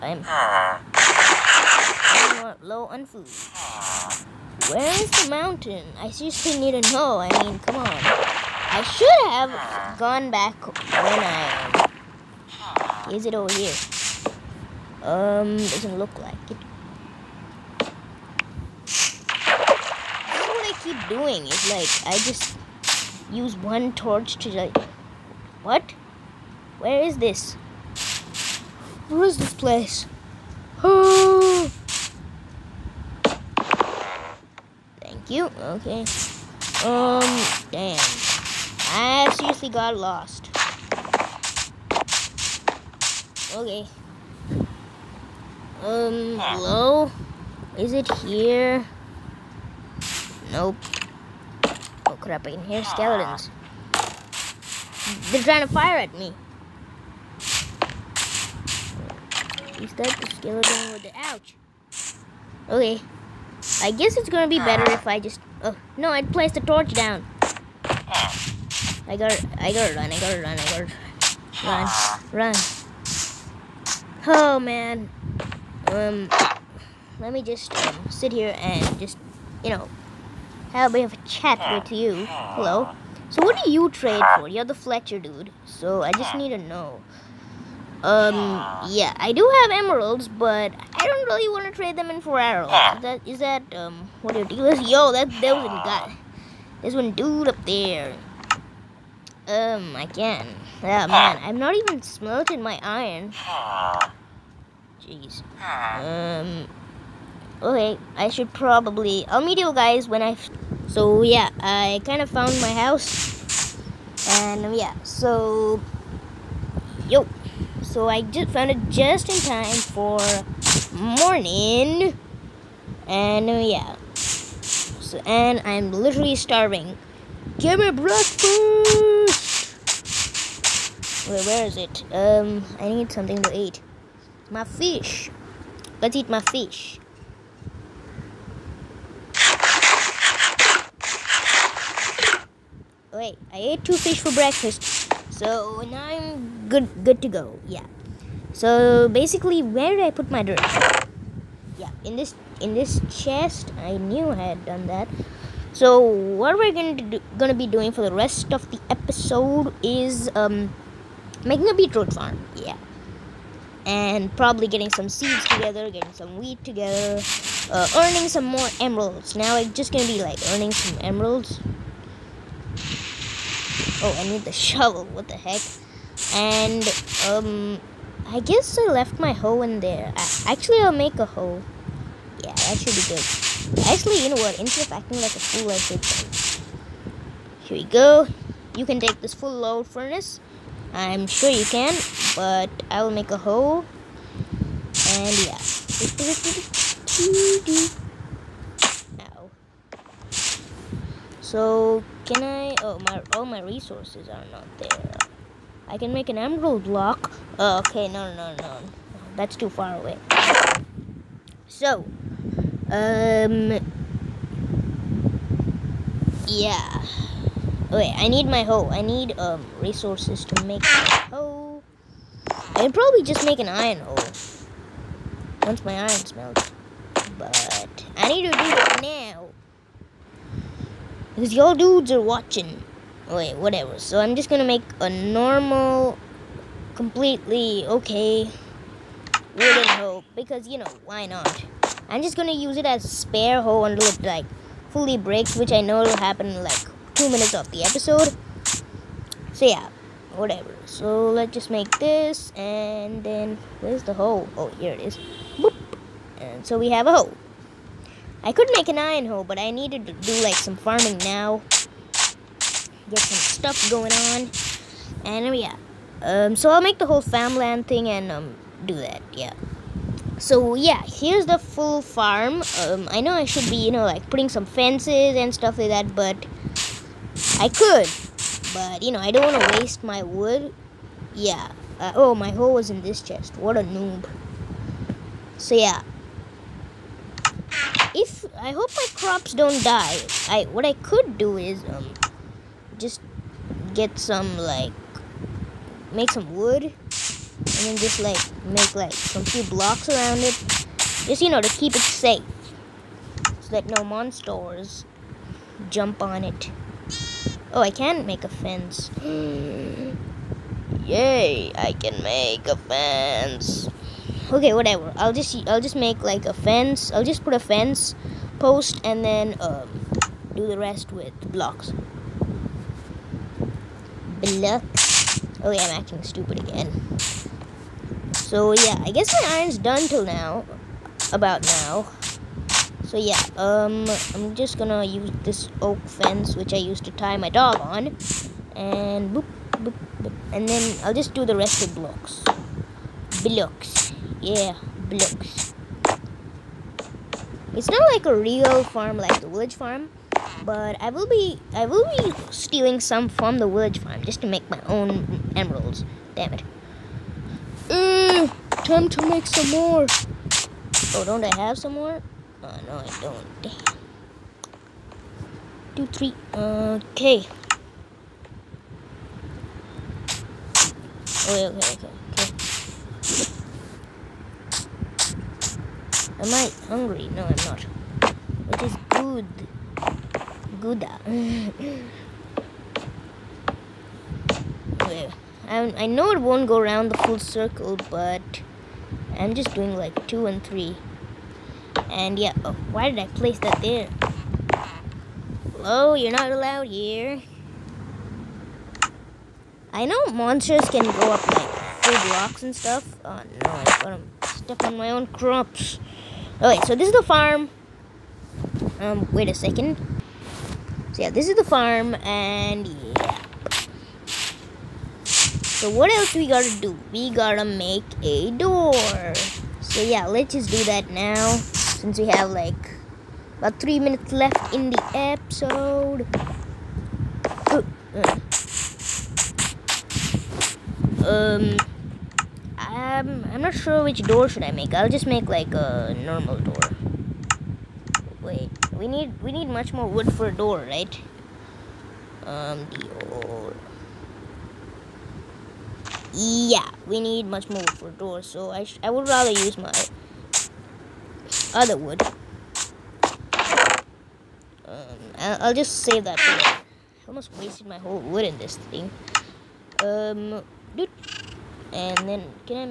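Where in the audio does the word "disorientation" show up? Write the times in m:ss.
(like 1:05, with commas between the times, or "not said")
not said.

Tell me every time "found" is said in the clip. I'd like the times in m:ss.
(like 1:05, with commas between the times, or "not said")
1:52, 1:58.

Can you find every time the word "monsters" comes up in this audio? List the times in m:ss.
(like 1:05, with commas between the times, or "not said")
5:04, 6:40.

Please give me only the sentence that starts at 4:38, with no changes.
But, you know, I don't want to waste my wood.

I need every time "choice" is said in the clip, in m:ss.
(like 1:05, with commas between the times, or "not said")
not said.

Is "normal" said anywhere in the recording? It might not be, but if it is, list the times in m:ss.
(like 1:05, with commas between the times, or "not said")
3:55, 7:16.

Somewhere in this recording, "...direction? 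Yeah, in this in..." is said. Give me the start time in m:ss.
2:30.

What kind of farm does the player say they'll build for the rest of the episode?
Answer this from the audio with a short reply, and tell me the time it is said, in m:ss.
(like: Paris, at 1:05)
beetroot farm, at 2:41.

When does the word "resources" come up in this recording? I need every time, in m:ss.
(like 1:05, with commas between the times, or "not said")
3:23, 3:39.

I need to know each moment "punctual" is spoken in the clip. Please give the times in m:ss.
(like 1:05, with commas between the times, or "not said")
not said.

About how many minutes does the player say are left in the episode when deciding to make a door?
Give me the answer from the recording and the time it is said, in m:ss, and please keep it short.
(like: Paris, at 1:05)
3, at 7:03.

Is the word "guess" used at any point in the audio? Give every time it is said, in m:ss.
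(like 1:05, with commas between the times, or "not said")
1:03, 2:58, 5:29.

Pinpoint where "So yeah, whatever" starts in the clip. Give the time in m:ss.
4:09.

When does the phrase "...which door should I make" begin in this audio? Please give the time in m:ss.
7:14.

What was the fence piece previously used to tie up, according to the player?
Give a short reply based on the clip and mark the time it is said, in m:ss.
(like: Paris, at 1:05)
dog, at 5:37.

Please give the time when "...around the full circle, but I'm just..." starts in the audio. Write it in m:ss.
6:26.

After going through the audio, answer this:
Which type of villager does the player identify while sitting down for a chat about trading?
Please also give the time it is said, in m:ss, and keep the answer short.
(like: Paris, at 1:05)
Fletcher, at 1:24.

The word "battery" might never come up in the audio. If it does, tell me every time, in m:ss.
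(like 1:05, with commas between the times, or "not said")
not said.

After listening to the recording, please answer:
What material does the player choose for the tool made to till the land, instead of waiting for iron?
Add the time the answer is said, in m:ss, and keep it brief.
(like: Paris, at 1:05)
wooden, at 3:59.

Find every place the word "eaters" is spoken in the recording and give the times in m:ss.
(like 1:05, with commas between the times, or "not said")
not said.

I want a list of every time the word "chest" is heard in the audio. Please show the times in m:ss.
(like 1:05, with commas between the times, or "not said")
2:33, 4:43.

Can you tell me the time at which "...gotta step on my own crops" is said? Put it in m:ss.
6:44.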